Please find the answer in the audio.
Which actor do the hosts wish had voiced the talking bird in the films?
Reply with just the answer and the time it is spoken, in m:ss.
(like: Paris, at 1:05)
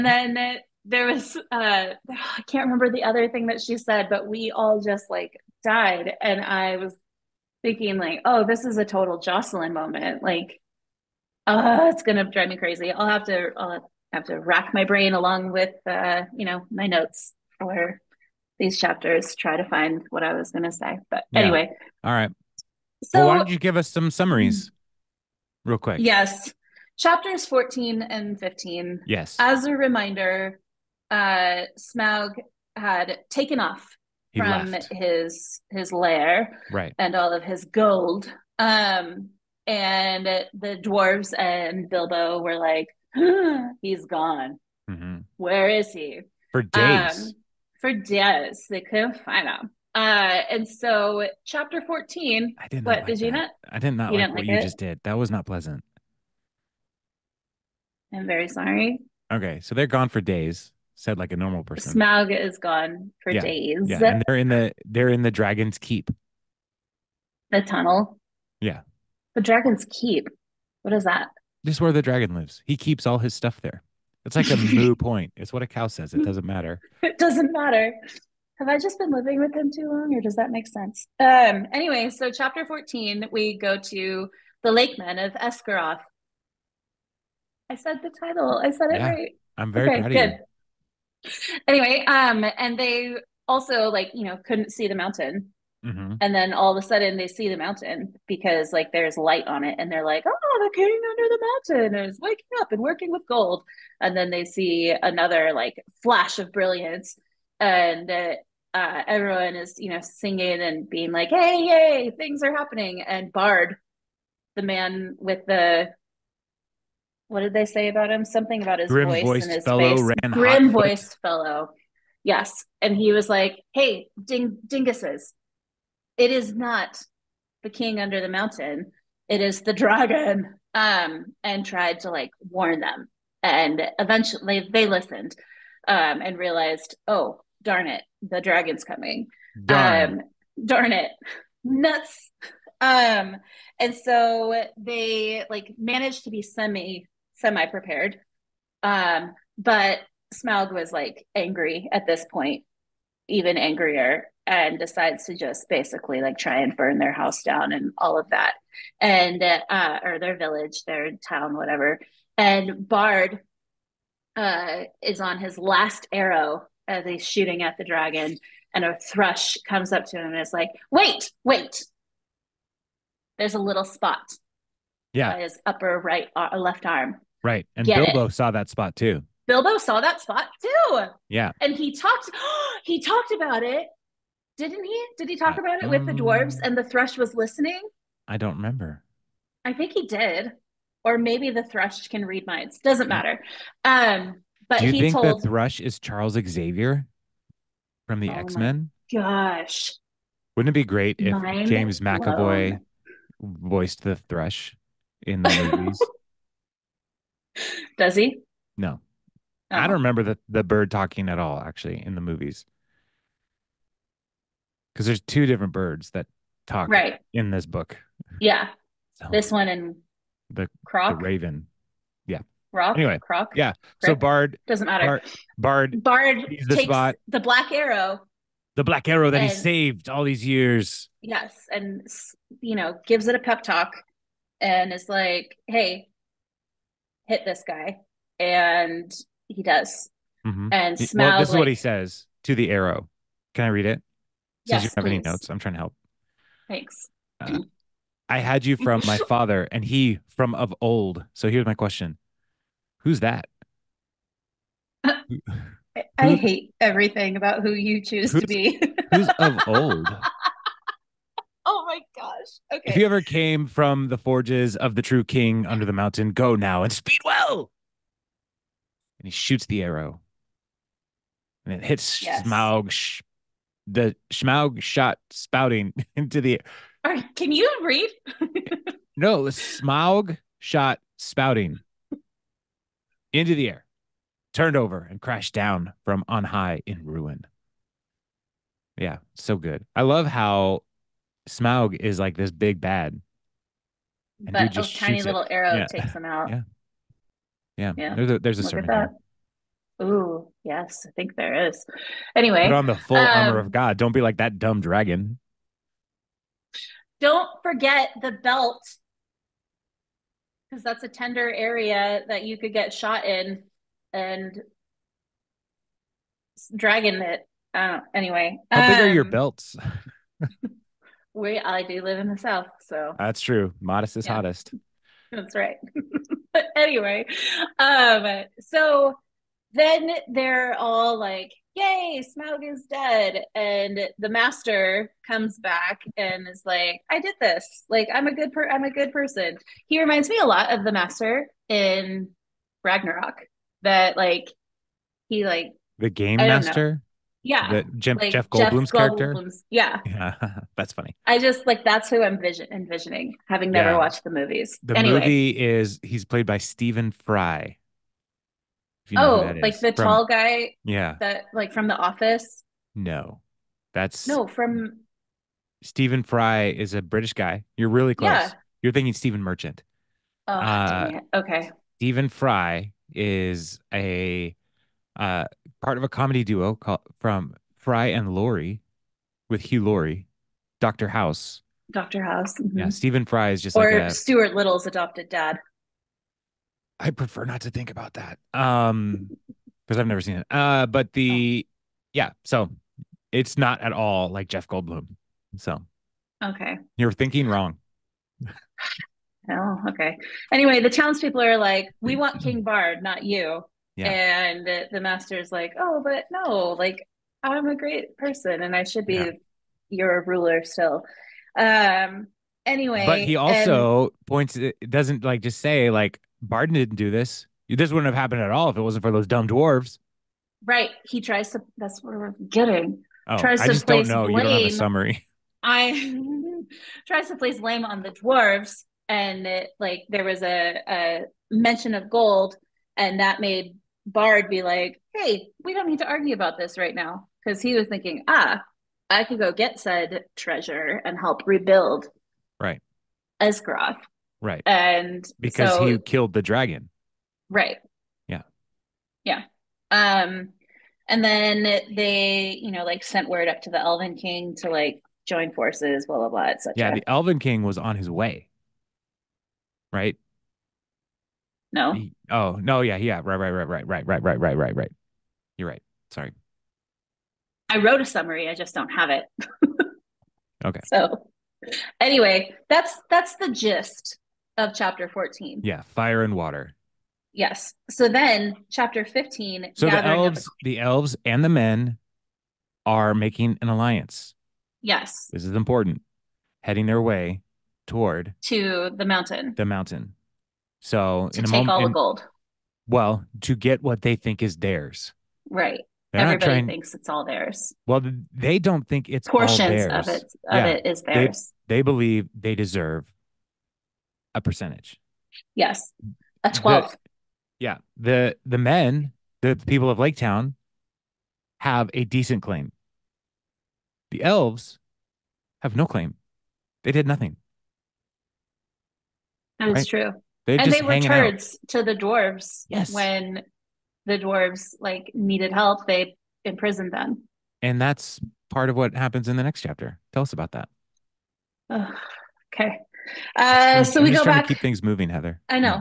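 James McAvoy, at 3:21.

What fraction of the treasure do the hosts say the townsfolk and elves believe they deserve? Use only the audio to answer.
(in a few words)
a twelfth.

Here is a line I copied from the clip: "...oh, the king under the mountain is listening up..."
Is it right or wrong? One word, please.
wrong.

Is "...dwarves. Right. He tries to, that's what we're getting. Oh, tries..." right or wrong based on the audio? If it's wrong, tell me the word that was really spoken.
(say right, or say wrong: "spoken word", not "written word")
right.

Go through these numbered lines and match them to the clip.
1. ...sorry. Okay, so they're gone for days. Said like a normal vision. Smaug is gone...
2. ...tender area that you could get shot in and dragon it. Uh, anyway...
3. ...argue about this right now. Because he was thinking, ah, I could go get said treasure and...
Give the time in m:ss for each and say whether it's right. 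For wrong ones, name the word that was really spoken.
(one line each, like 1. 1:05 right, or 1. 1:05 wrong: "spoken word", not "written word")
1. 0:58 wrong: "person", not "vision"
2. 5:11 right
3. 7:16 right.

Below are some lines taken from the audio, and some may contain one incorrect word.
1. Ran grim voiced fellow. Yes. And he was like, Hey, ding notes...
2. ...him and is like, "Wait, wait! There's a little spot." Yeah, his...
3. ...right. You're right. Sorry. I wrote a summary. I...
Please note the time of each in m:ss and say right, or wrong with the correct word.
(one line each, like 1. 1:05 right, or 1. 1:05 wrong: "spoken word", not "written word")
1. 2:00 wrong: "dinguses", not "notes"
2. 2:50 right
3. 7:44 right.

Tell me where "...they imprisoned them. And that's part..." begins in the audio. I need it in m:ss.
8:45.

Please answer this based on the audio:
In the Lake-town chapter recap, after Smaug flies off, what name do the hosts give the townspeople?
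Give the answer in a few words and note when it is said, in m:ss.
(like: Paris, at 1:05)
Lakemen of Esgaroth, at 1:24.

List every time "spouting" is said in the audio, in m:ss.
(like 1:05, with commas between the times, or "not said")
4:35, 4:41.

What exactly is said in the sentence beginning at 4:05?
any notes, I'm trying to help.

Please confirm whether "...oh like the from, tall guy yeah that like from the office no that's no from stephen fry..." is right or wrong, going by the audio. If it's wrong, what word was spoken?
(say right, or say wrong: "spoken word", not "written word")
right.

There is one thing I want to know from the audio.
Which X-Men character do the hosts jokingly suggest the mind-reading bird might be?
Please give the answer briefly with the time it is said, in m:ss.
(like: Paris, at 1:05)
Charles Xavier, at 3:15.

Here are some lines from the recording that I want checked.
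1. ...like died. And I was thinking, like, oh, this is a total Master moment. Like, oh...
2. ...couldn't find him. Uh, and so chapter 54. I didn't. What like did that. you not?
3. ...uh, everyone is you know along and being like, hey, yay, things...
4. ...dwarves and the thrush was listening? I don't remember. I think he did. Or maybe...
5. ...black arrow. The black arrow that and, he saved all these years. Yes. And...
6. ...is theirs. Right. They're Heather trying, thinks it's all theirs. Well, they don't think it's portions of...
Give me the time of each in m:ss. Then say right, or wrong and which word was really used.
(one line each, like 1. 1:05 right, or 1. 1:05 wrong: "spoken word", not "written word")
1. 0:05 wrong: "Jocelyn", not "Master"
2. 0:48 wrong: "14", not "54"
3. 1:48 wrong: "singing", not "along"
4. 3:06 right
5. 3:47 right
6. 8:14 wrong: "Everybody", not "Heather".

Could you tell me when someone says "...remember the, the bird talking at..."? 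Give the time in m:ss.
3:29.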